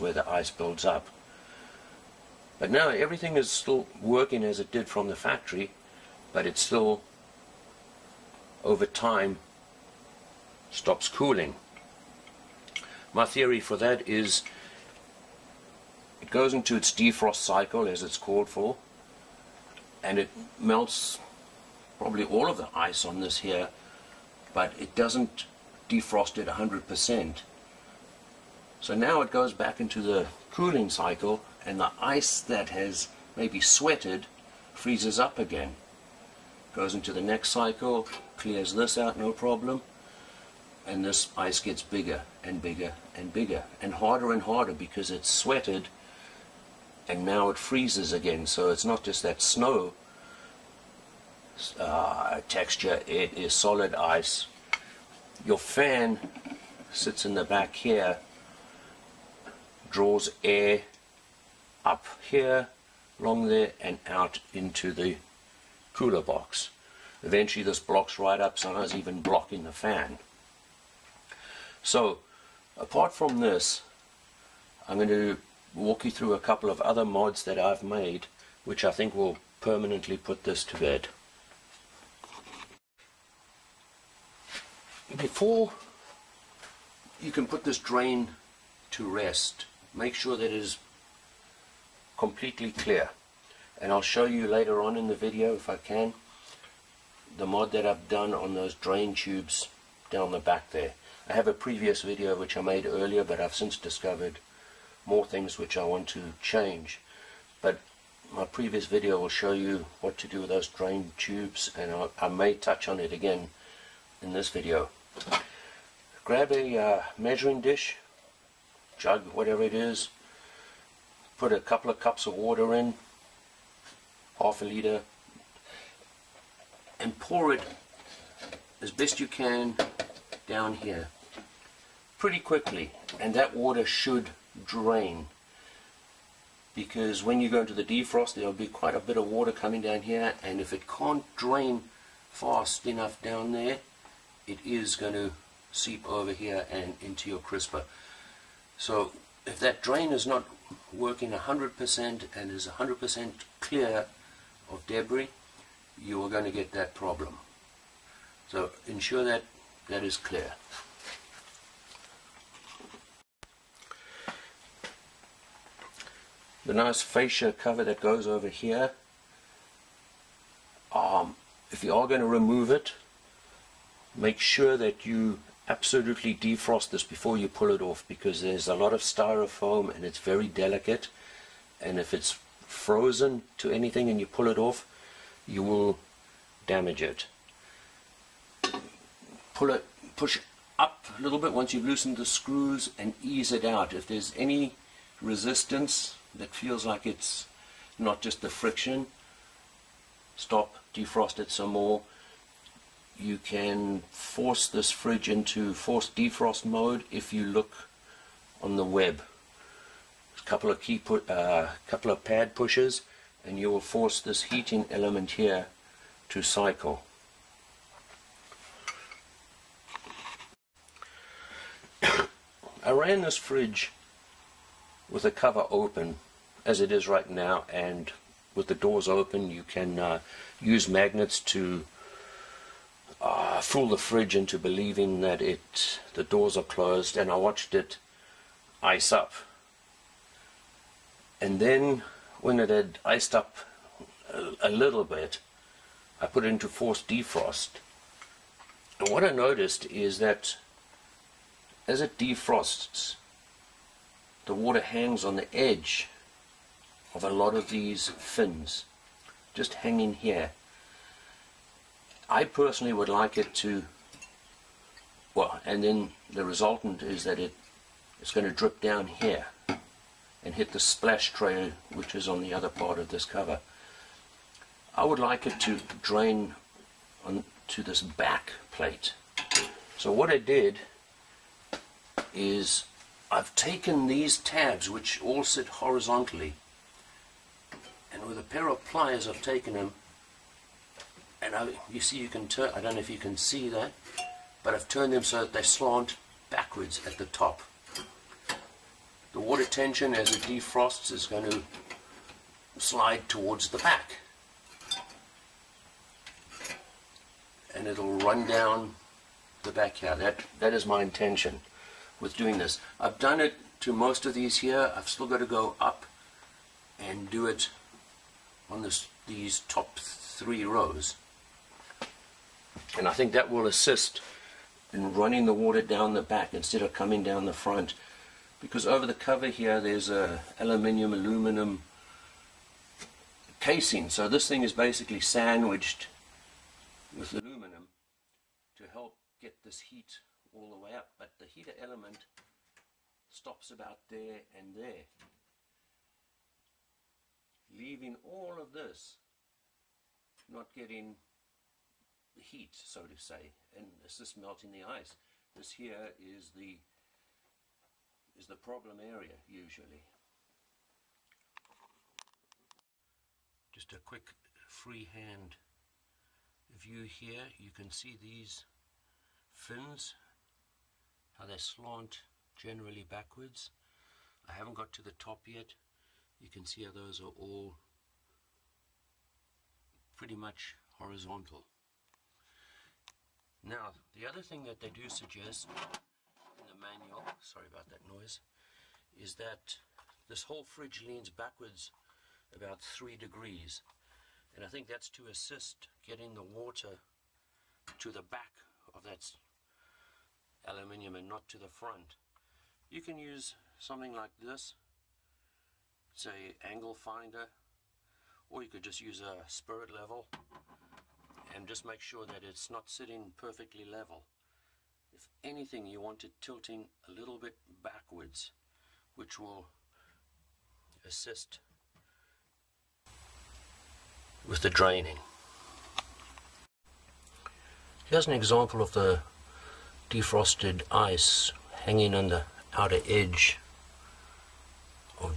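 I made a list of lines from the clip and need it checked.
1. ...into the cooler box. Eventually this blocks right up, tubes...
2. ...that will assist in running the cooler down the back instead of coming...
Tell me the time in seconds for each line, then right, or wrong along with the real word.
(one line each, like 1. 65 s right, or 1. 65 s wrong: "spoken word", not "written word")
1. 64 s wrong: "sometimes", not "tubes"
2. 323 s wrong: "water", not "cooler".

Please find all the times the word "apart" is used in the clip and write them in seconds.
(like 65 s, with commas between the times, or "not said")
72 s.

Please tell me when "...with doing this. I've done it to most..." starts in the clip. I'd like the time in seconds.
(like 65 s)
312 s.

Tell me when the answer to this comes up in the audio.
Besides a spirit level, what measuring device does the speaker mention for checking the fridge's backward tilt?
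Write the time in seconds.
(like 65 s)
406 s.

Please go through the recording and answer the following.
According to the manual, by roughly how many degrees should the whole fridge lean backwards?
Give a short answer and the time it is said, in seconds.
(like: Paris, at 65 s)
3 degrees, at 392 s.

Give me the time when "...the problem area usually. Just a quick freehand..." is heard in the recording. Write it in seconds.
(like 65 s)
358 s.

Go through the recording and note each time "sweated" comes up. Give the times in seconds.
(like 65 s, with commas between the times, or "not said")
33 s, 45 s.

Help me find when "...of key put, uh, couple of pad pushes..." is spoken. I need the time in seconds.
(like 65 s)
210 s.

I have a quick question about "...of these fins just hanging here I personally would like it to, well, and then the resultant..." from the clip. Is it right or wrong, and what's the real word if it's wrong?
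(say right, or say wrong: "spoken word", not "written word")
right.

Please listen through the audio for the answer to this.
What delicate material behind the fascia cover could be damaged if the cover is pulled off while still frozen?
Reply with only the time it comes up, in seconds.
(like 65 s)
179 s.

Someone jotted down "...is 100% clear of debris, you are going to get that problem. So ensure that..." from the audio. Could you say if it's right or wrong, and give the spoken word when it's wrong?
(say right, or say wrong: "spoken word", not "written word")
right.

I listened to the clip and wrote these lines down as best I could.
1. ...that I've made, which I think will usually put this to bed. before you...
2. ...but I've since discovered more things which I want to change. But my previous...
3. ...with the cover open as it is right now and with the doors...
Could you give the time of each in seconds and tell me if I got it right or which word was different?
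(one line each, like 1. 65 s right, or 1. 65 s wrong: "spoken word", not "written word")
1. 77 s wrong: "permanently", not "usually"
2. 103 s right
3. 225 s right.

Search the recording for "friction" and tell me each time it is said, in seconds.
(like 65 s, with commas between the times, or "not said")
198 s.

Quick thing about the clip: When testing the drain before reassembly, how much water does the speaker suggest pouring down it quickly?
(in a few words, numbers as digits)
half a liter.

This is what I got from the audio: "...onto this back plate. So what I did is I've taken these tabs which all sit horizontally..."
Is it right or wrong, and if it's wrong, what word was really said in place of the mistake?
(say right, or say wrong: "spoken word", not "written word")
right.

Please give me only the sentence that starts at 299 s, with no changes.
The water tension as it defrosts is going to slide towards the back.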